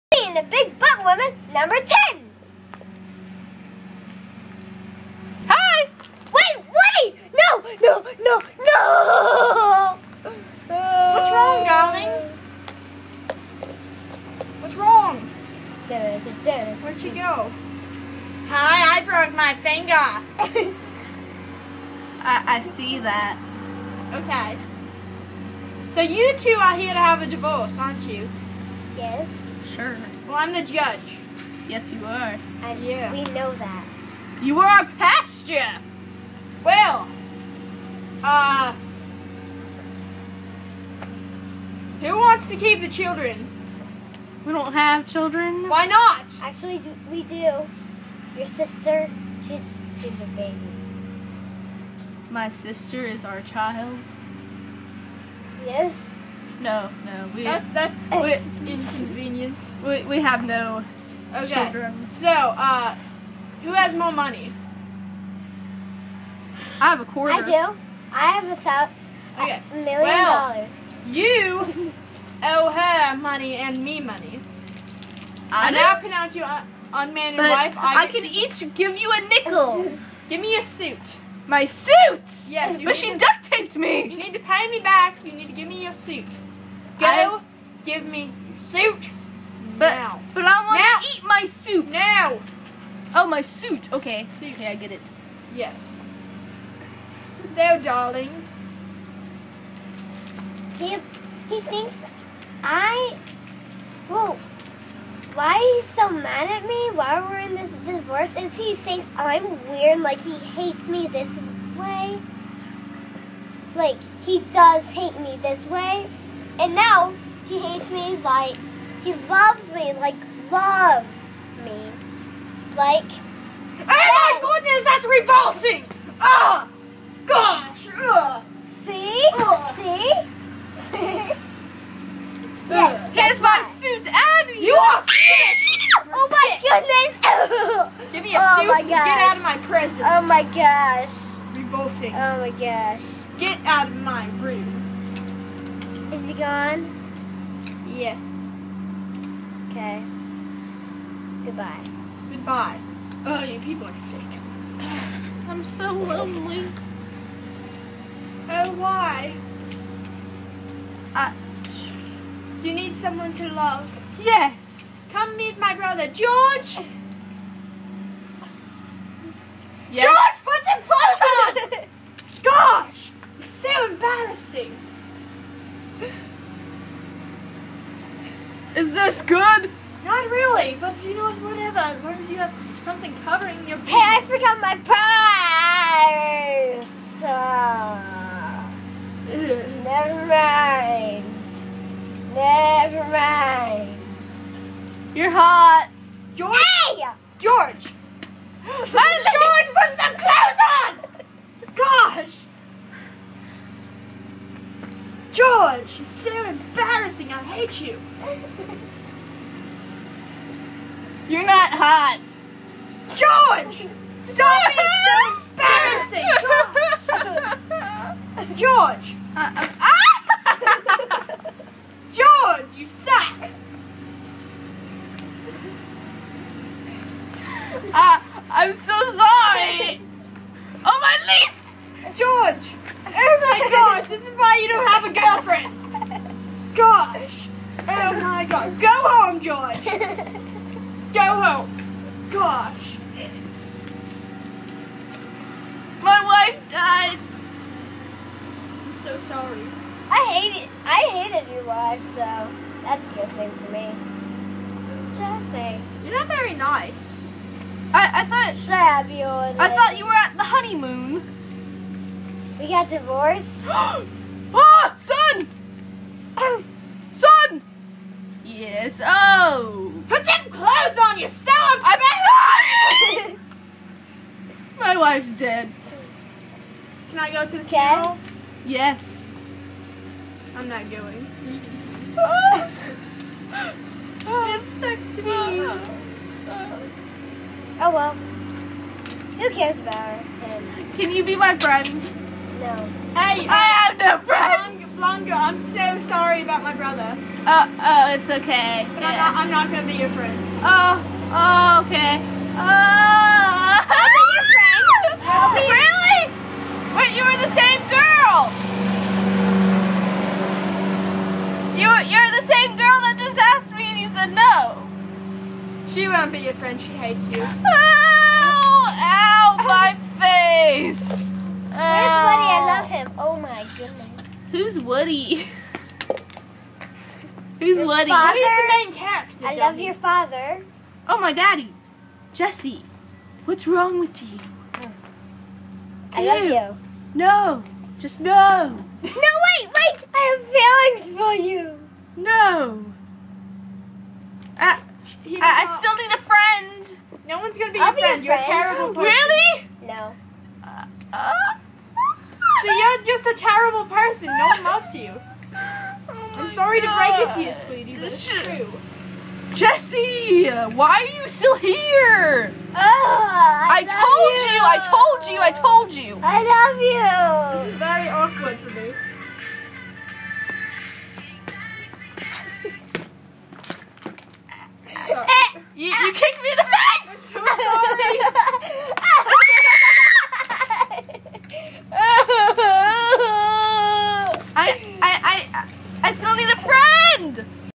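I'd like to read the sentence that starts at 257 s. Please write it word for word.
I, I thought Shabby I thought you were at the honeymoon.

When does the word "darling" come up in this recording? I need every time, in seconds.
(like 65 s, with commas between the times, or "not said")
11 s, 97 s.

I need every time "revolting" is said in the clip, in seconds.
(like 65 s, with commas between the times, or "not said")
125 s, 141 s.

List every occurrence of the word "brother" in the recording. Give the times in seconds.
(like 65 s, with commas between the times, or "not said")
165 s, 296 s.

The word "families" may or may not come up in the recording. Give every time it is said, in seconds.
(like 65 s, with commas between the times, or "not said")
not said.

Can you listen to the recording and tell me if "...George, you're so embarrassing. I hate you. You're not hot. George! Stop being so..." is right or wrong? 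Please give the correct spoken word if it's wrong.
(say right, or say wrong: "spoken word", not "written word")
right.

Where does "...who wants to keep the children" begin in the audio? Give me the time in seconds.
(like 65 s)
41 s.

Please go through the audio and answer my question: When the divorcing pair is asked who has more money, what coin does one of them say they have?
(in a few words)
a quarter.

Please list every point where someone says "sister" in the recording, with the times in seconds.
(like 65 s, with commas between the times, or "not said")
48 s, 52 s.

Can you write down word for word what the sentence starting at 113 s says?
Like, he does hate me this way, and now he hates me like he loves me, like loves me.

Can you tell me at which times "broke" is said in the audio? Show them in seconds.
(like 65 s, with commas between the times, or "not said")
19 s.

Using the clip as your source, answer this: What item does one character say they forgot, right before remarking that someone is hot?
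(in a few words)
purse.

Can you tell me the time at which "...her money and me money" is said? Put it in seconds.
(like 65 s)
72 s.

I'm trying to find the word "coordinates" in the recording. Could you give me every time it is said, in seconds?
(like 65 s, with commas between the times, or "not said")
not said.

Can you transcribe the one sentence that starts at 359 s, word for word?
Jesse, why are you still here?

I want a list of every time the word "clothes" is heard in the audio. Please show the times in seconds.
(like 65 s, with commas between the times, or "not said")
170 s, 270 s.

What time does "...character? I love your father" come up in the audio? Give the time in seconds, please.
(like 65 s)
328 s.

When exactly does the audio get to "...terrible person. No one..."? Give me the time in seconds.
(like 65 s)
353 s.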